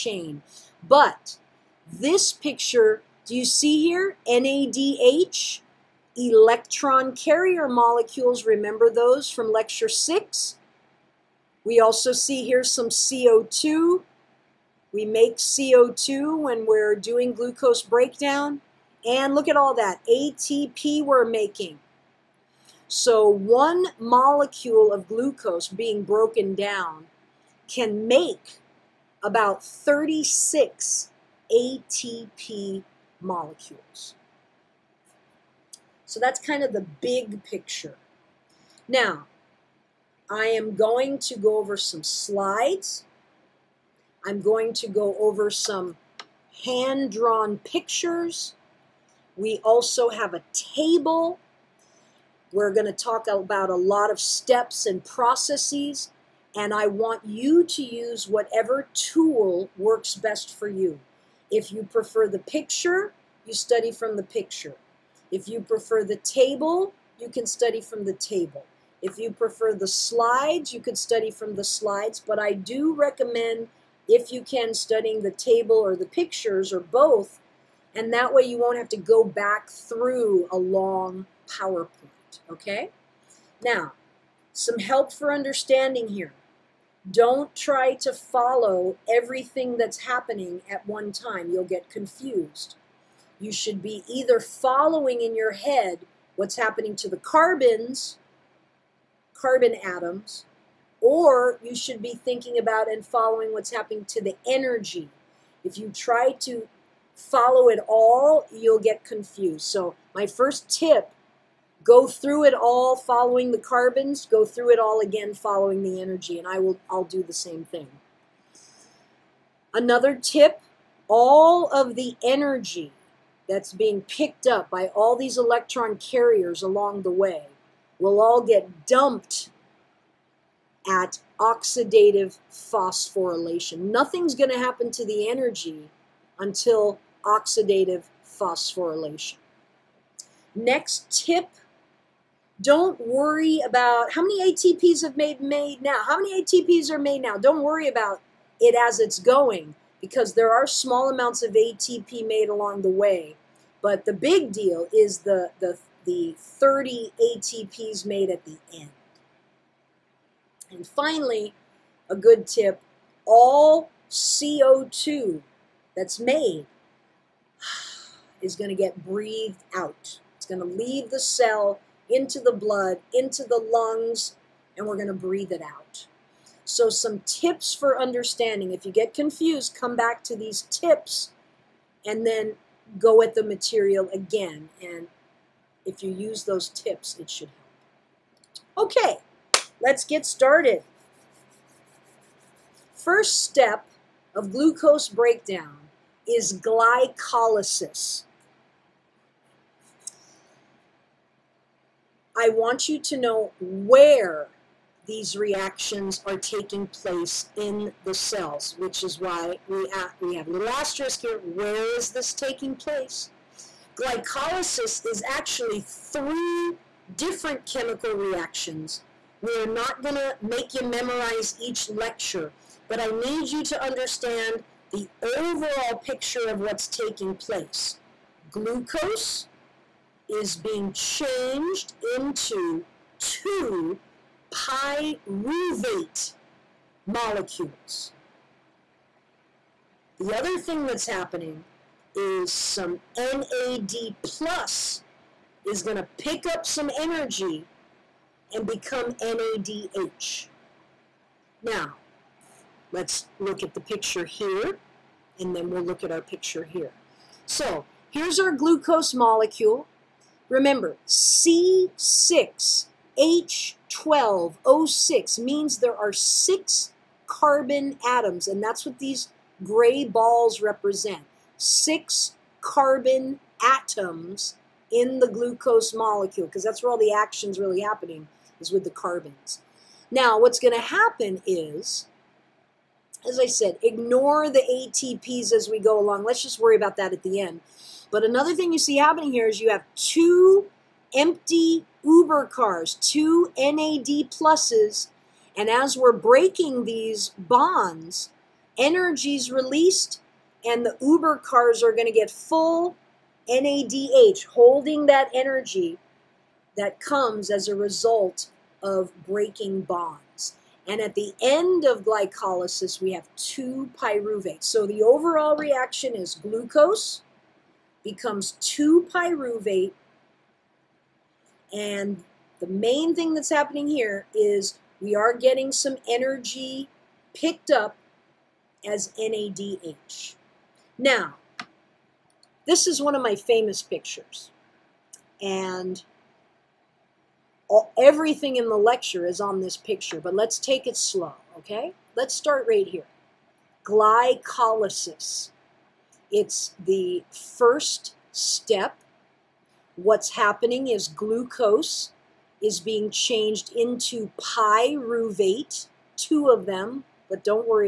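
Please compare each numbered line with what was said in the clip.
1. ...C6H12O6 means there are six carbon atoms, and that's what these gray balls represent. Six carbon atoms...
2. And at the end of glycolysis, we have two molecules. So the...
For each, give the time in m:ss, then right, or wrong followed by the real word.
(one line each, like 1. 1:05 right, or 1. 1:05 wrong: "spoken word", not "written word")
1. 4:21 right
2. 5:10 wrong: "pyruvates", not "molecules".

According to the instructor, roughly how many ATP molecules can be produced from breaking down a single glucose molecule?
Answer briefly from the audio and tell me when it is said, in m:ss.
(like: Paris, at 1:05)
36, at 0:29.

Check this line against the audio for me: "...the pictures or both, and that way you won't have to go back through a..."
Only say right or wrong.
right.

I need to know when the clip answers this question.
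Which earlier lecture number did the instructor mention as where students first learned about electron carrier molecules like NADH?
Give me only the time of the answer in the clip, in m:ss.
0:09.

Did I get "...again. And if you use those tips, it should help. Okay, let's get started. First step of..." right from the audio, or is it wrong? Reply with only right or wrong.
right.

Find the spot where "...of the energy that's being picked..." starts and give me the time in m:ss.
2:01.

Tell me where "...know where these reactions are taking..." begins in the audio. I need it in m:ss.
3:23.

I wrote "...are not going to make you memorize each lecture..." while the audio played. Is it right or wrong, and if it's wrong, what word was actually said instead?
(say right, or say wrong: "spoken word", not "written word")
right.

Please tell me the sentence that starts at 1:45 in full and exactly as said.
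If you try to follow it all, you'll get confused.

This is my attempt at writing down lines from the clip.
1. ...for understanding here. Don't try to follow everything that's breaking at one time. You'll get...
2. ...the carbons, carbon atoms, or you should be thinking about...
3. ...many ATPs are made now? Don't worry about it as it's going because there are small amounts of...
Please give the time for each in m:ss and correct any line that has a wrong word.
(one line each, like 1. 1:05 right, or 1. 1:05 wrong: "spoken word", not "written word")
1. 1:25 wrong: "happening", not "breaking"
2. 1:37 right
3. 2:26 right.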